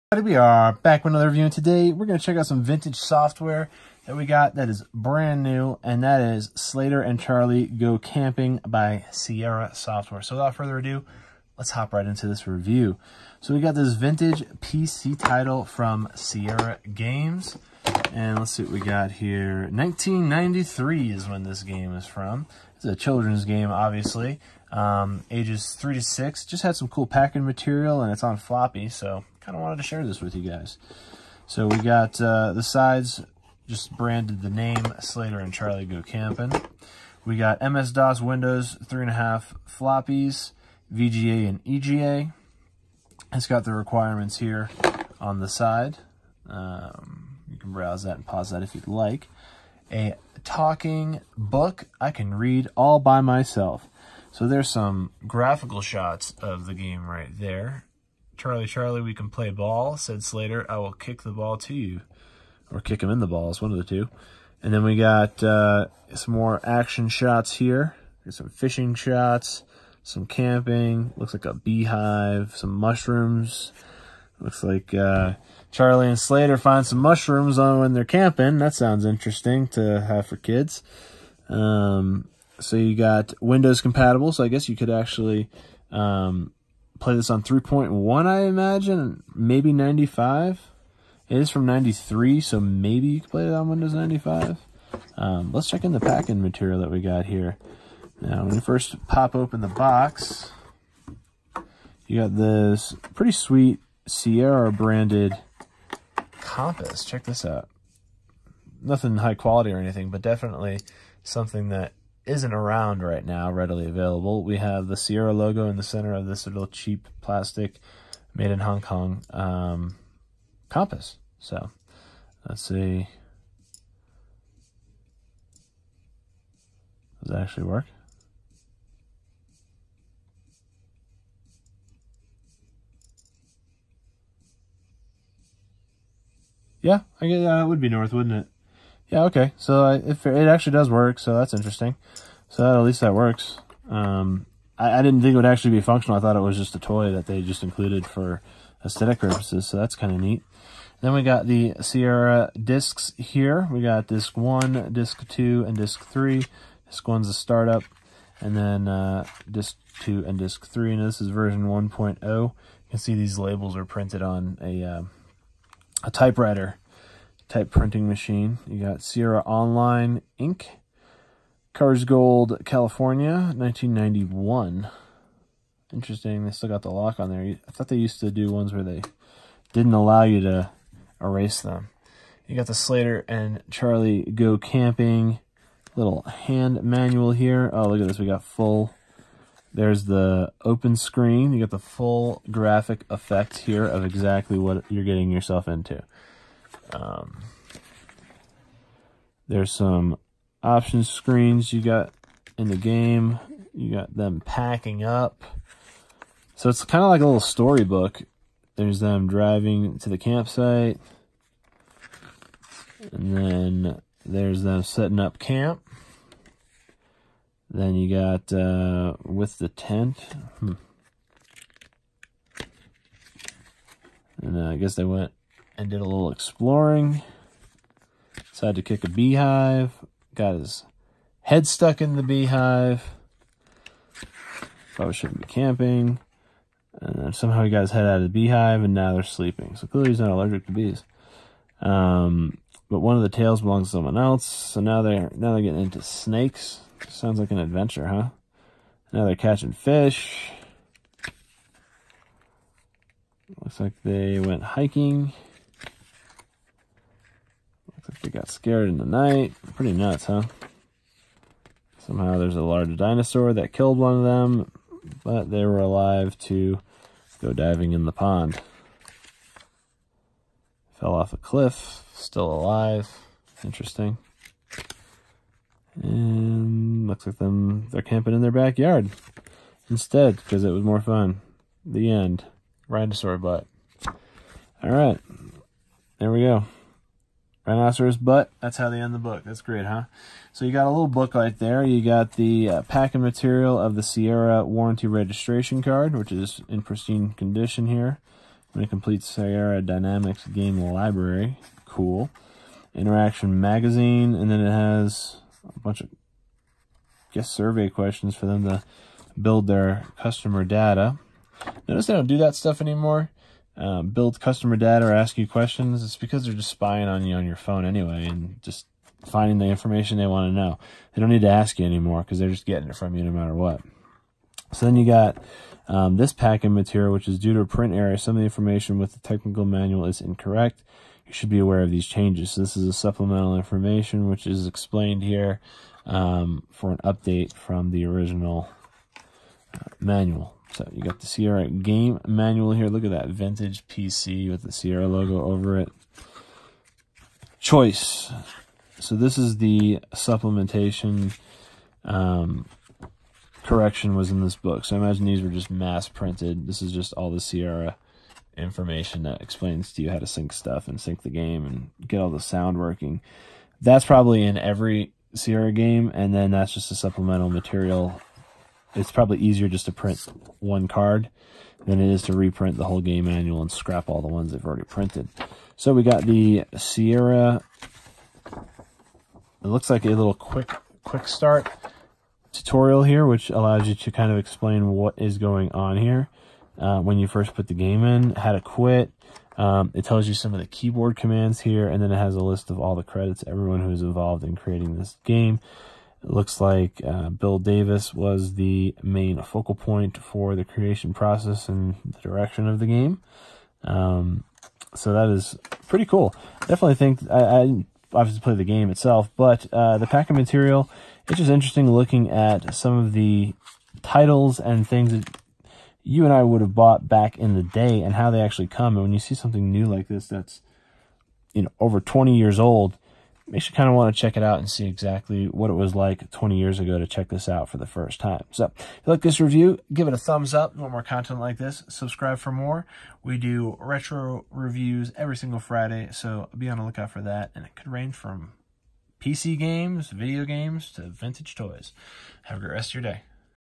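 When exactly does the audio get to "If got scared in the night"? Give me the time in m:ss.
4:18.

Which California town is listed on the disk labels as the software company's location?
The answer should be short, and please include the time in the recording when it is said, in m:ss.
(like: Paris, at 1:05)
Coarsegold, at 2:51.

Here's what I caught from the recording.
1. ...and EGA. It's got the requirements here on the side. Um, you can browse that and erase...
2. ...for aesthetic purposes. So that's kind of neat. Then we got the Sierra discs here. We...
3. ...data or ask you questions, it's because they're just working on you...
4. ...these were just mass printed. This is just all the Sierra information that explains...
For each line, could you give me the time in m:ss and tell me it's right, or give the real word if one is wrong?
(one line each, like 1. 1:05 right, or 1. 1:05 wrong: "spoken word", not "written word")
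1. 0:41 wrong: "pause", not "erase"
2. 2:28 right
3. 5:14 wrong: "spying", not "working"
4. 5:55 right.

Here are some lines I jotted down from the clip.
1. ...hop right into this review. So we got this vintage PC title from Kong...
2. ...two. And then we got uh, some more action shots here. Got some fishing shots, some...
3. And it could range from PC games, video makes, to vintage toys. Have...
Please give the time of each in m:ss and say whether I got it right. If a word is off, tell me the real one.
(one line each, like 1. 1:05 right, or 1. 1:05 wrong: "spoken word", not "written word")
1. 0:11 wrong: "Sierra", not "Kong"
2. 1:03 right
3. 7:17 wrong: "games", not "makes".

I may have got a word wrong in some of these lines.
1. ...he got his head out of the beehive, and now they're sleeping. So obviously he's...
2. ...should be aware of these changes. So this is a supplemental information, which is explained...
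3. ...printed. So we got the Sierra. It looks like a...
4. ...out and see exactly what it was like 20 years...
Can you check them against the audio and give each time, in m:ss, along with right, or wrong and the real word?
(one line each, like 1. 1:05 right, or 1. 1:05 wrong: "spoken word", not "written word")
1. 3:57 wrong: "clearly", not "obviously"
2. 5:31 right
3. 6:14 right
4. 7:04 right.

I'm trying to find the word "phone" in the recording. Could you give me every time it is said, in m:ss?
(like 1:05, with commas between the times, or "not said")
5:17.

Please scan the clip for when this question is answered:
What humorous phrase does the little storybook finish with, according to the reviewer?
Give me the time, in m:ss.
4:47.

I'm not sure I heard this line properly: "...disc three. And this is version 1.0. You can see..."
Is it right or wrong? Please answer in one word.
right.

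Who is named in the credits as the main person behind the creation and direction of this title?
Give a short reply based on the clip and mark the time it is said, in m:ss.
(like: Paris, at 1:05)
Bill Davis, at 6:37.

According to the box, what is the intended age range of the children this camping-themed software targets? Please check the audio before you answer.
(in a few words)
3 to 6.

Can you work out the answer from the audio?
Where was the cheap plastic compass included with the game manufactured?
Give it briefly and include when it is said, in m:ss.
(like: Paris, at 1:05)
Hong Kong, at 1:58.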